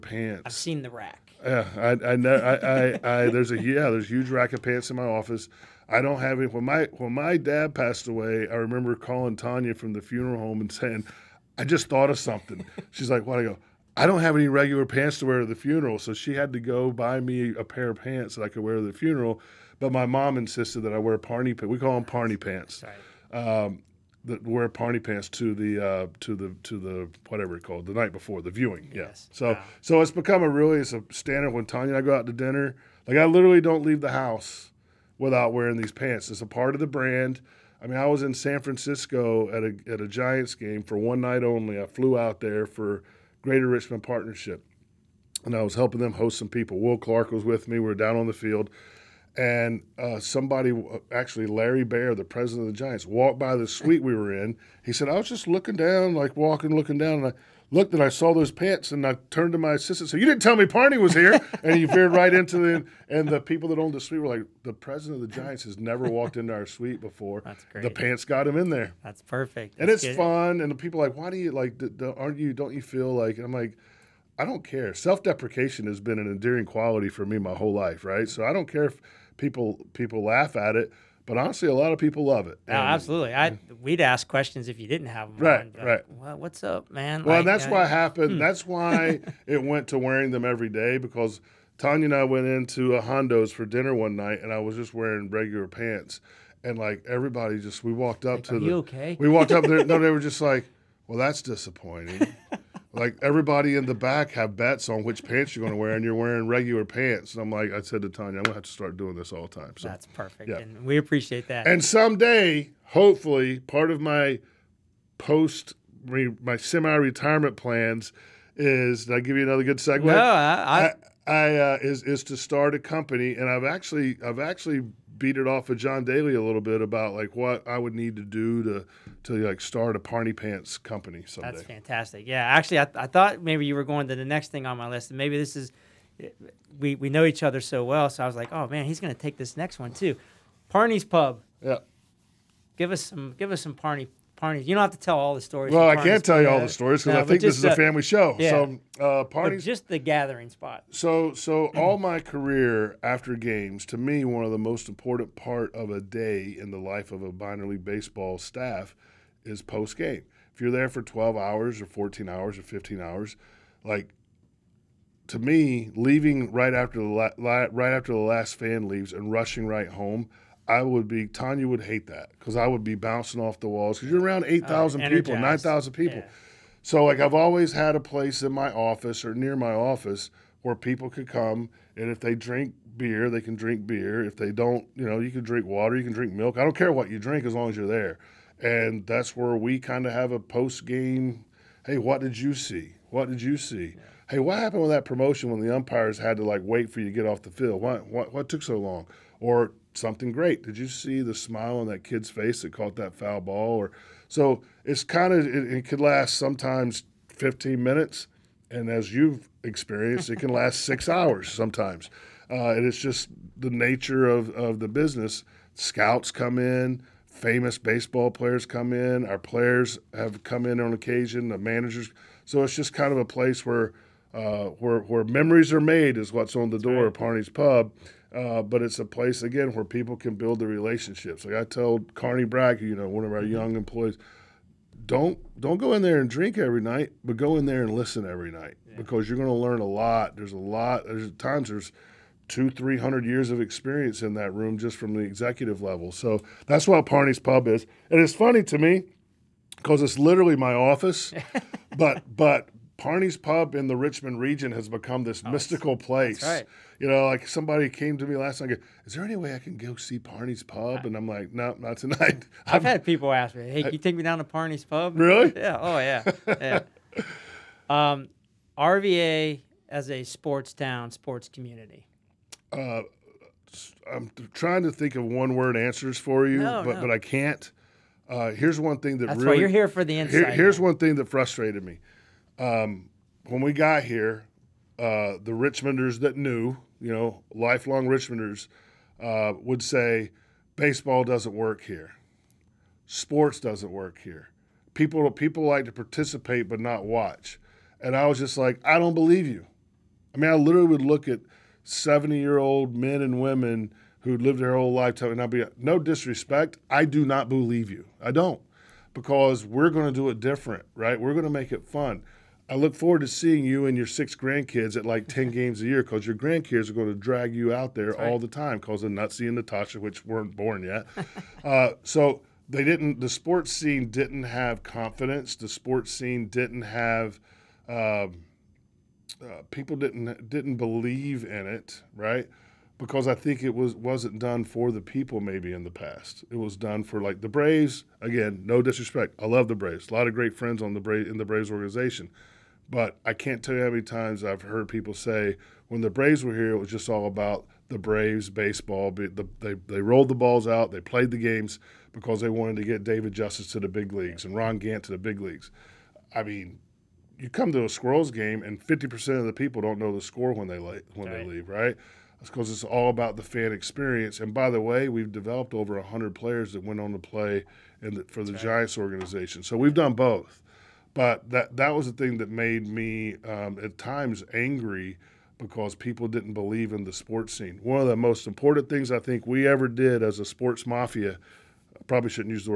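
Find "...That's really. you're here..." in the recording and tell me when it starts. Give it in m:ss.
4:39.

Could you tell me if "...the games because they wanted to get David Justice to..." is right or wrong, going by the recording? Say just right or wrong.
right.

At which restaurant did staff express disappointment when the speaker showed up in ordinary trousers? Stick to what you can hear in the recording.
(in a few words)
Hondo's.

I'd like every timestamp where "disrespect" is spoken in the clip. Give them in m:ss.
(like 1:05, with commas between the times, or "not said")
5:05, 5:38.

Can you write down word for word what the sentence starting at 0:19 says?
But my mom insisted that I wear Parney pants.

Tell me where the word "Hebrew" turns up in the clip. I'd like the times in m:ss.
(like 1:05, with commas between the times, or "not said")
not said.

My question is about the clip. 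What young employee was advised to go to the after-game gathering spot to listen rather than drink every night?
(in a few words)
Carney Bragg.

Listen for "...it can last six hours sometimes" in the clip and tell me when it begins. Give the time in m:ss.
3:30.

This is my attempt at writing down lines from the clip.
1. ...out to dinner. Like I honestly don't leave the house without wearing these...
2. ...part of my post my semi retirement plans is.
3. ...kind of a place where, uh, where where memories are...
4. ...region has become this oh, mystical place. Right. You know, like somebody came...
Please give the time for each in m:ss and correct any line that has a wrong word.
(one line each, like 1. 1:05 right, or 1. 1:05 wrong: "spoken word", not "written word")
1. 0:32 wrong: "literally", not "honestly"
2. 1:53 right
3. 3:42 right
4. 4:14 right.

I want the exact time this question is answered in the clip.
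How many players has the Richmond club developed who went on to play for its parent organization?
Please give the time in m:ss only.
6:05.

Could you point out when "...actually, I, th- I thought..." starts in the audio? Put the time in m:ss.
2:12.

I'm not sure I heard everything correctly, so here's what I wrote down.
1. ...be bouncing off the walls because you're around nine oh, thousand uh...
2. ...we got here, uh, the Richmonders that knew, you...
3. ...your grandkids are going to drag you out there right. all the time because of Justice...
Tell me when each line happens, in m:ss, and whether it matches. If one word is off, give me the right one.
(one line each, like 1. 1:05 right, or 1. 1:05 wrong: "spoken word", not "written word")
1. 2:52 wrong: "eight", not "nine"
2. 4:43 right
3. 5:16 wrong: "Nutsy", not "Justice".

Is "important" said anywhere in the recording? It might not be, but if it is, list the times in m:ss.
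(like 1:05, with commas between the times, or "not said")
2:34, 6:18.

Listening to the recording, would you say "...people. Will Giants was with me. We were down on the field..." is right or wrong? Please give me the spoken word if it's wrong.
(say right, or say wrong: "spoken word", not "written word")
wrong: "Clark", not "Giants".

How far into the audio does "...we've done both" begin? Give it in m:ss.
6:09.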